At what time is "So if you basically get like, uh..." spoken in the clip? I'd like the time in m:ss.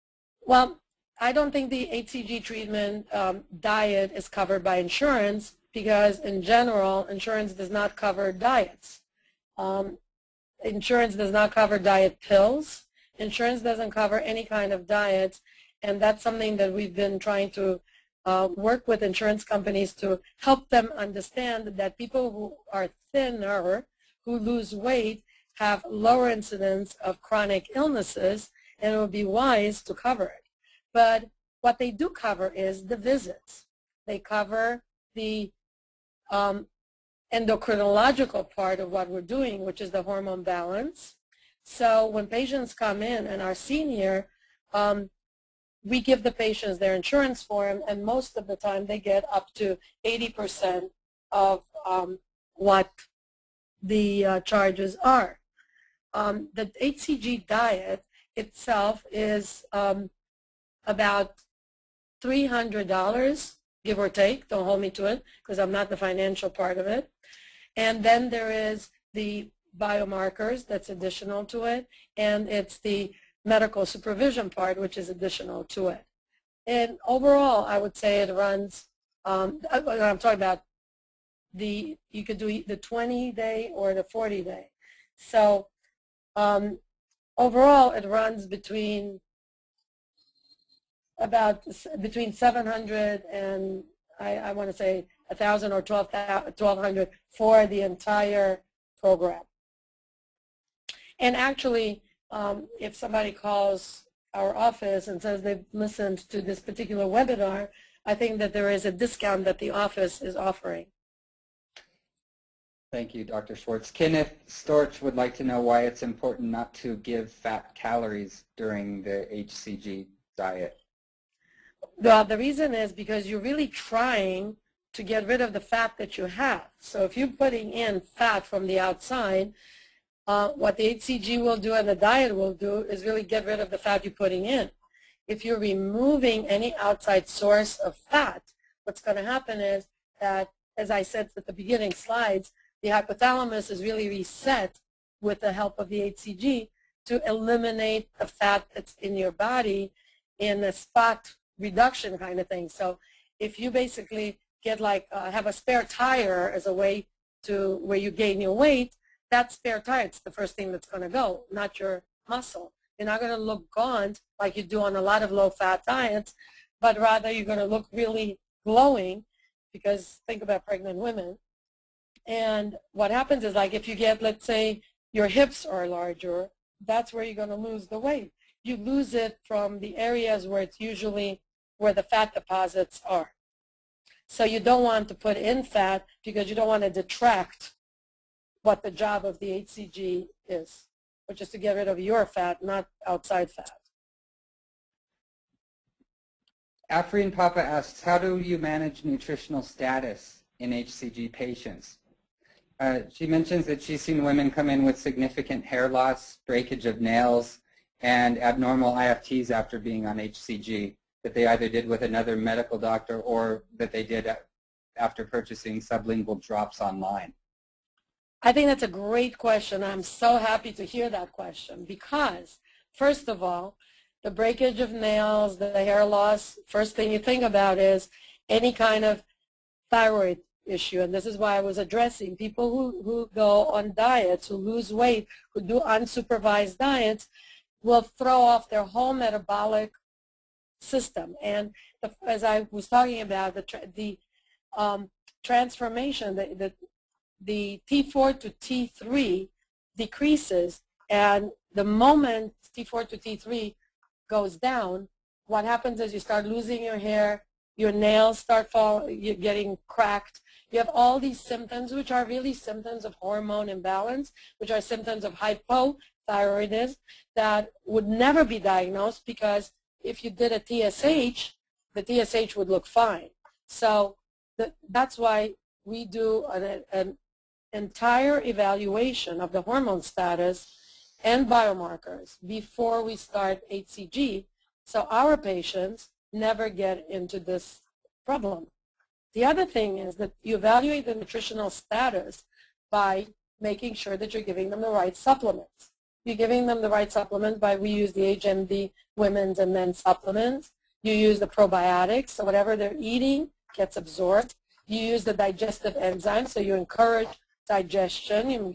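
2:32.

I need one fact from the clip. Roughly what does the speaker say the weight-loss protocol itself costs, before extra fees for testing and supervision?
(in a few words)
$300.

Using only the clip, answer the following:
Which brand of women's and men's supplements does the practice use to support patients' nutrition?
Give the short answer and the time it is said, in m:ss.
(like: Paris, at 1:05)
HMD, at 4:58.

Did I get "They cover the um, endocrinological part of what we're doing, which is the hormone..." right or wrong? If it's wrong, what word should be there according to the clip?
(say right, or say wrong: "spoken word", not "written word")
right.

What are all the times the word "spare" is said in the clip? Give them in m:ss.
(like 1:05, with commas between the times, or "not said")
2:35, 2:39.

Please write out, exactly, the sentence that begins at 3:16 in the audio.
Afreen Papa asks, how do you manage nutritional status in HCG patients?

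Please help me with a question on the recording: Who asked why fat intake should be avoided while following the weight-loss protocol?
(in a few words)
Kenneth Storch.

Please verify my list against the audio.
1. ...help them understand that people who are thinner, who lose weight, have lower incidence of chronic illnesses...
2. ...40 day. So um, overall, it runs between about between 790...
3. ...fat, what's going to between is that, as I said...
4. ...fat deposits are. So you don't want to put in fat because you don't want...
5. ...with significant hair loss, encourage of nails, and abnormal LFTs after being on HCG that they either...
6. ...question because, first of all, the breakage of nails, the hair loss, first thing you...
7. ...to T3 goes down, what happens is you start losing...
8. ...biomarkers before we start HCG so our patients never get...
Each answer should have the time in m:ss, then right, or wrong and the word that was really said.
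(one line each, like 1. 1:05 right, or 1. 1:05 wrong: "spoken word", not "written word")
1. 0:20 right
2. 1:24 wrong: "700", not "790"
3. 2:17 wrong: "happen", not "between"
4. 3:02 right
5. 3:24 wrong: "breakage", not "encourage"
6. 3:41 right
7. 4:13 right
8. 4:41 right.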